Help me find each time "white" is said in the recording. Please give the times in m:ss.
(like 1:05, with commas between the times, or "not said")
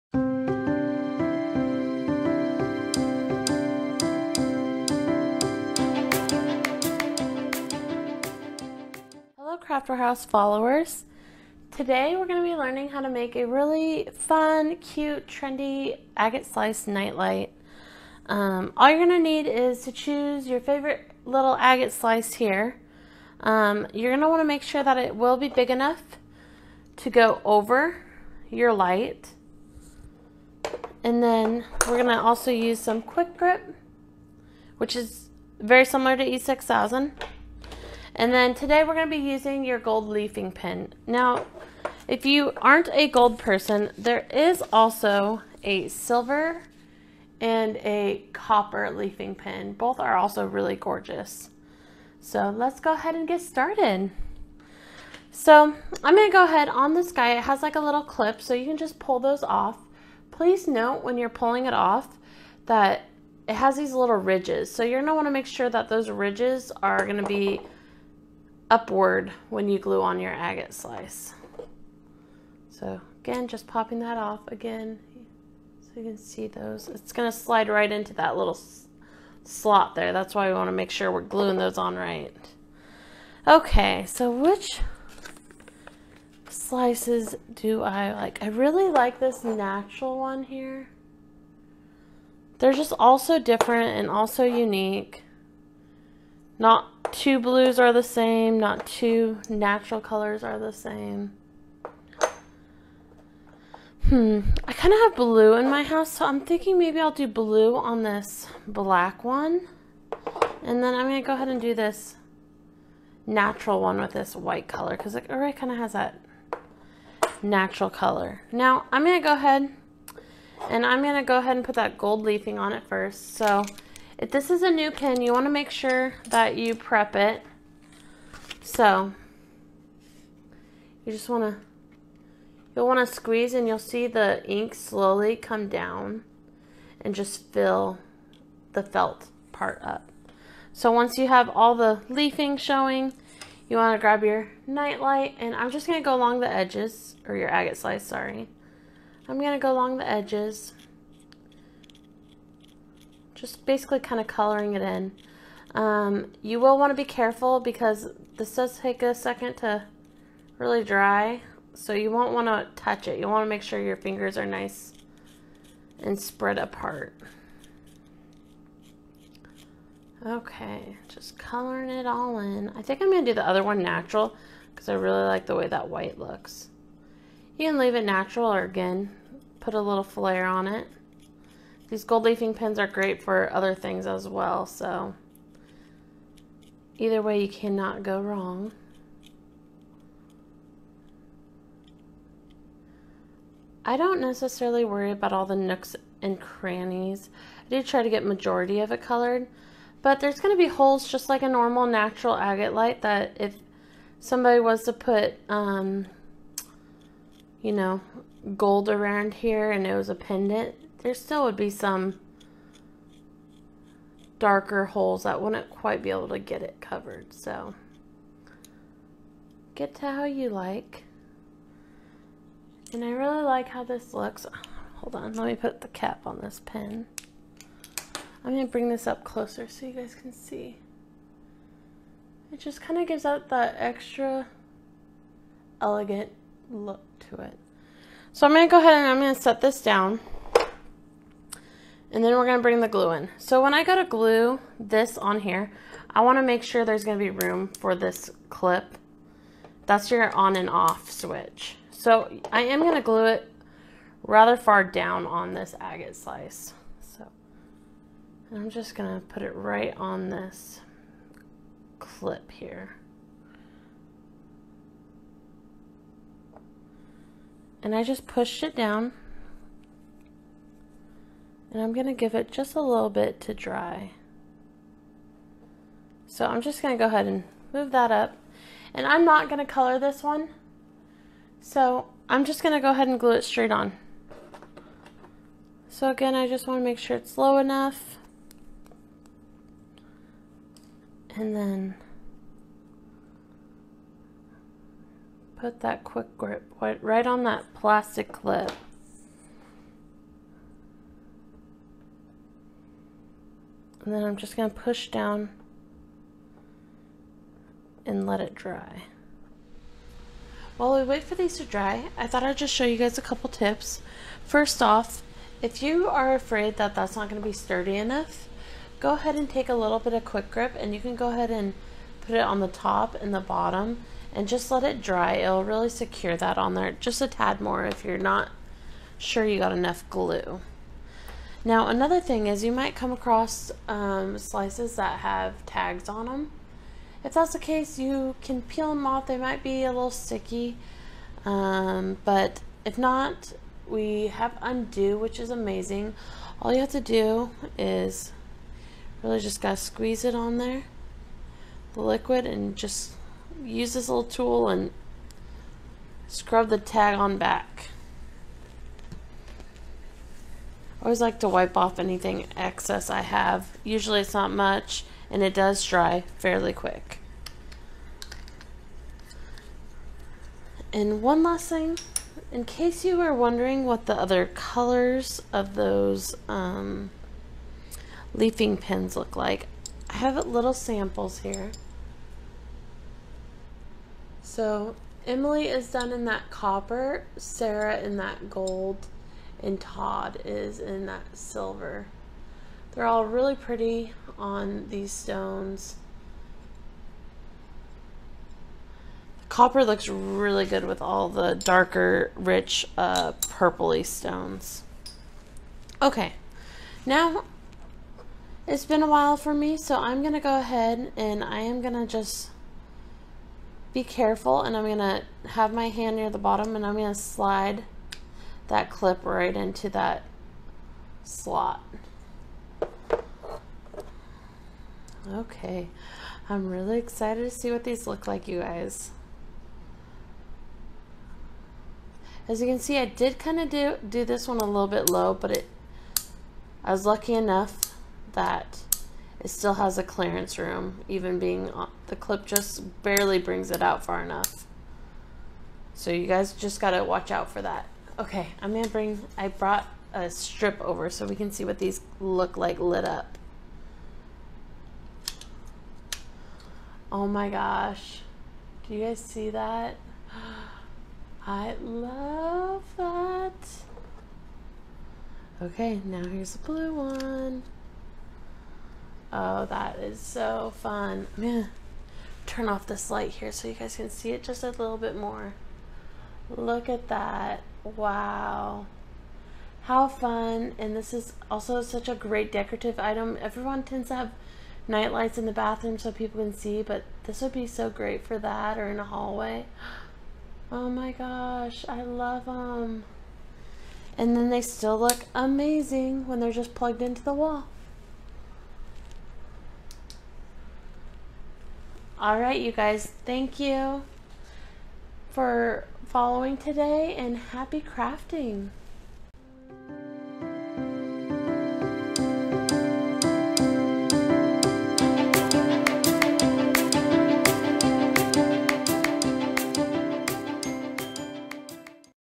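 1:54, 2:55.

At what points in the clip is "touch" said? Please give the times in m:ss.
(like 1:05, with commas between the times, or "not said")
2:42.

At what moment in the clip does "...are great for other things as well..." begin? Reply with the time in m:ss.
3:02.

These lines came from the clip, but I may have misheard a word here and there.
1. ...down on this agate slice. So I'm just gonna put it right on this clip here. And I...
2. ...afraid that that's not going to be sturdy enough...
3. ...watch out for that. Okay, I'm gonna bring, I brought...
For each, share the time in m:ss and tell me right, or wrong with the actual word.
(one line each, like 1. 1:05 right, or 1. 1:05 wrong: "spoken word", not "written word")
1. 4:14 right
2. 5:16 right
3. 7:27 right.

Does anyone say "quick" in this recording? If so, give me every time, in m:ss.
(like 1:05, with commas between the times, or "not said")
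0:33, 4:56, 5:20, 6:06.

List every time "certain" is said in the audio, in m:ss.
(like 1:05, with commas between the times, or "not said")
not said.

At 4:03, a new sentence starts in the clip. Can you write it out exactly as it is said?
So when I go to glue this on here, I wanna make sure there's gonna be room for this clip.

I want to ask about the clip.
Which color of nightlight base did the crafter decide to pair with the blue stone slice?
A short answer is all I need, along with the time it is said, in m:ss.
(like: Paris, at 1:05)
Black, at 1:48.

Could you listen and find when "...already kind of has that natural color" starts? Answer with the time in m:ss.
1:55.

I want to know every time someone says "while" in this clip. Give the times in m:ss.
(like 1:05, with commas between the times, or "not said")
5:10, 6:49.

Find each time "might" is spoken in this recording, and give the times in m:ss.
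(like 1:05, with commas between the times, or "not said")
5:32, 5:39.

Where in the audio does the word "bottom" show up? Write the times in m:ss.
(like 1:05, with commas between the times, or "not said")
5:23, 6:56.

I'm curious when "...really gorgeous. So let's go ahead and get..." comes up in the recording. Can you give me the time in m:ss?
0:50.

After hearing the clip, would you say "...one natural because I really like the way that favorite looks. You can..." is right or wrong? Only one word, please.
wrong.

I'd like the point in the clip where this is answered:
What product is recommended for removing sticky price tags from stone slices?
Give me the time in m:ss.
5:44.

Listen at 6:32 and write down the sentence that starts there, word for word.
They're all really pretty on these stones.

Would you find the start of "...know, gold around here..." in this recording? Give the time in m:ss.
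3:27.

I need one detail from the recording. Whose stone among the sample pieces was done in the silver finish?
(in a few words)
Todd.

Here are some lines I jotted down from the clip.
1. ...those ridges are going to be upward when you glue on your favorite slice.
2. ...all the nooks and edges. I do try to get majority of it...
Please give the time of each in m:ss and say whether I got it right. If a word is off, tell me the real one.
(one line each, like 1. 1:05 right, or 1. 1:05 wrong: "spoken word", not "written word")
1. 1:05 wrong: "agate", not "favorite"
2. 3:15 wrong: "crannies", not "edges".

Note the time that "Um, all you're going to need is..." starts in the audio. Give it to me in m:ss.
0:18.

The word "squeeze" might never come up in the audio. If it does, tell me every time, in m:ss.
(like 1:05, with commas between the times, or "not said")
2:13, 5:49.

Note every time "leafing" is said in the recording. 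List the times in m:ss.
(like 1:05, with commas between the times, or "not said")
0:40, 0:48, 2:02, 2:22, 3:02, 6:18.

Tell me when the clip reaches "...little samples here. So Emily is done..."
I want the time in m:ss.
6:20.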